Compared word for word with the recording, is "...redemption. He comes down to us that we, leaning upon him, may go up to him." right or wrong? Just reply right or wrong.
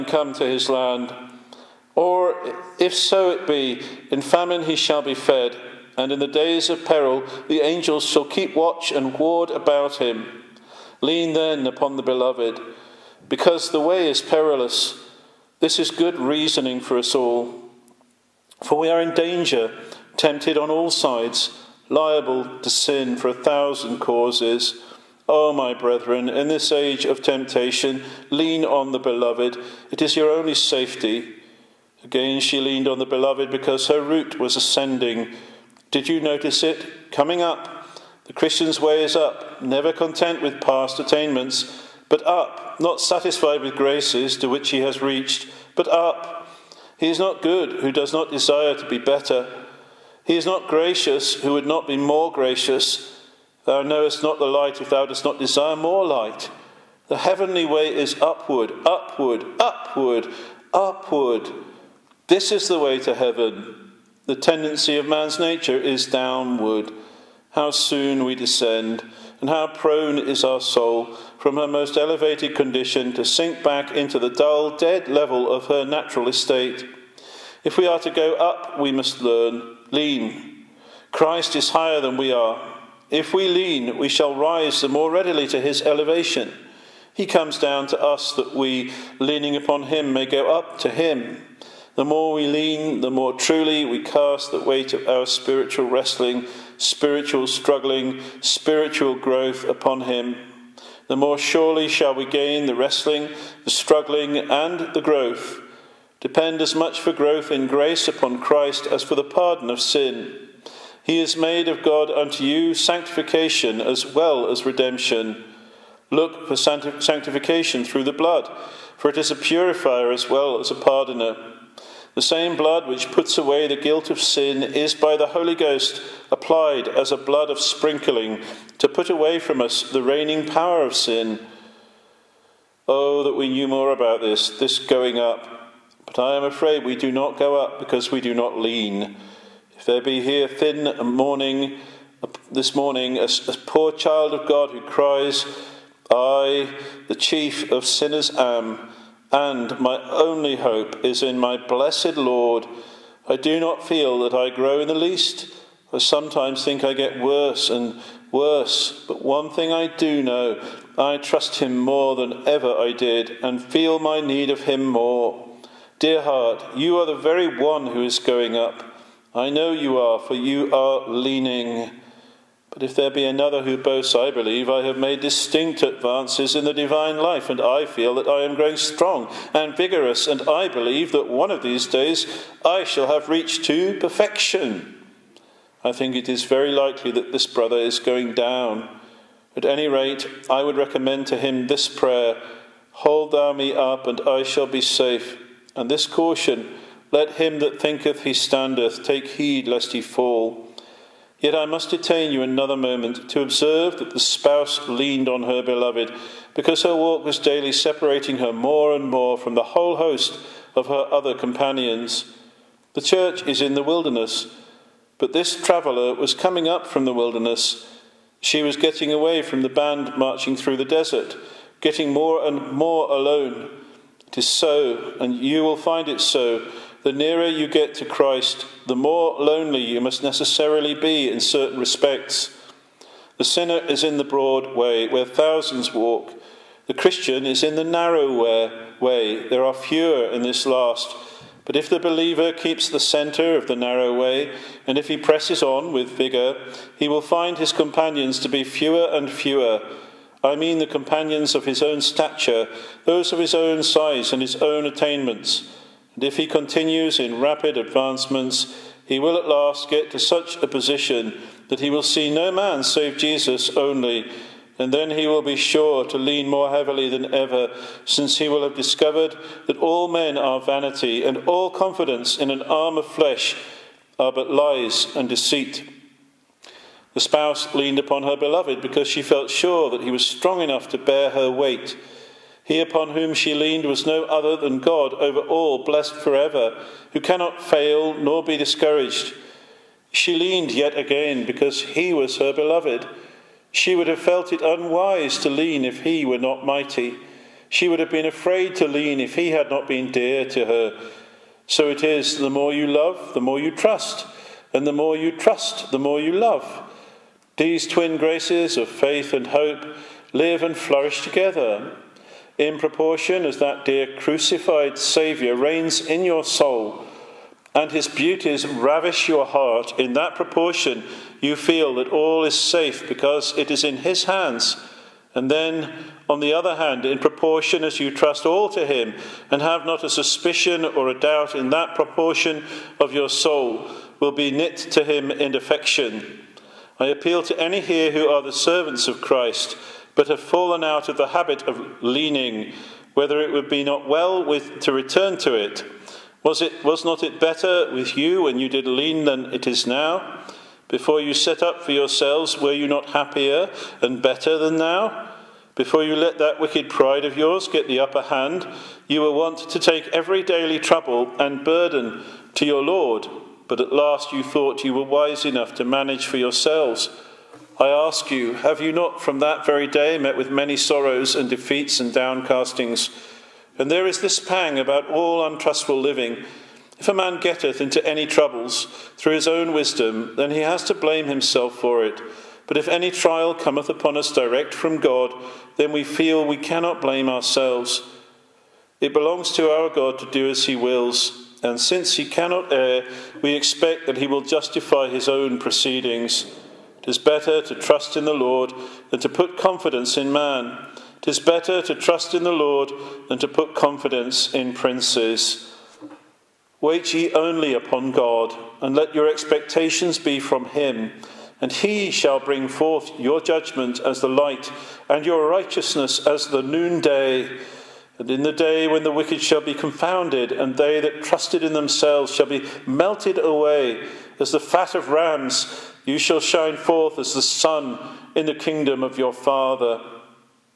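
wrong.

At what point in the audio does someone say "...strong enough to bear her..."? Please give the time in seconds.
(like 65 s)
280 s.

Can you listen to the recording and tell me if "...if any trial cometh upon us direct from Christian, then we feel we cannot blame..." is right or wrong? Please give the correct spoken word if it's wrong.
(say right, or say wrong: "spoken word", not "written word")
wrong: "God", not "Christian".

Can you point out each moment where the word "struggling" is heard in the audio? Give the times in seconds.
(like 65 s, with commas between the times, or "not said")
97 s, 103 s.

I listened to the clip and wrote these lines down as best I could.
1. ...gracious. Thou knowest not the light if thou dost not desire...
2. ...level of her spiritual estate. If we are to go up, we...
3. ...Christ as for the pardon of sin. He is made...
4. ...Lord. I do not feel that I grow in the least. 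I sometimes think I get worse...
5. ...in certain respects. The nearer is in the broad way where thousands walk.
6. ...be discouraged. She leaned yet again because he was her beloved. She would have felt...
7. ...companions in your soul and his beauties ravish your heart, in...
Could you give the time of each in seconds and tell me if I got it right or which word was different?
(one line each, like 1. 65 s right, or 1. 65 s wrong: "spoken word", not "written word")
1. 52 s right
2. 75 s wrong: "natural", not "spiritual"
3. 108 s right
4. 152 s right
5. 231 s wrong: "sinner", not "nearer"
6. 288 s right
7. 315 s wrong: "reigns", not "companions".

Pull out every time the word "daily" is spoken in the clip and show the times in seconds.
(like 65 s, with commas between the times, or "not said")
207 s, 360 s.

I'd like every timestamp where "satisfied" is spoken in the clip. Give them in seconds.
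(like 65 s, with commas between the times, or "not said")
43 s.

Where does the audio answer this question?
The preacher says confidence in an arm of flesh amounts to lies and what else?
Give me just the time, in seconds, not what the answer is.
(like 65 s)
275 s.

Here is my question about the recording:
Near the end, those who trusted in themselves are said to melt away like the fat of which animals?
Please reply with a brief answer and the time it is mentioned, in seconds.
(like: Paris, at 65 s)
Rams, at 425 s.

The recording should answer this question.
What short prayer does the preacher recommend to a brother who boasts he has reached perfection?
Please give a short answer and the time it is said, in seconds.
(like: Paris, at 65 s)
Hold thou me up, and I shall be safe, at 192 s.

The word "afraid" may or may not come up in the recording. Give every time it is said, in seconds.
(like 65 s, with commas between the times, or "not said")
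136 s, 298 s.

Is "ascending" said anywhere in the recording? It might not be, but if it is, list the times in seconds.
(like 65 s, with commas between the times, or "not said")
34 s.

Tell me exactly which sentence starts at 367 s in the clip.
I ask you, have you not from that very day met with many sorrows and defeats and downcastings?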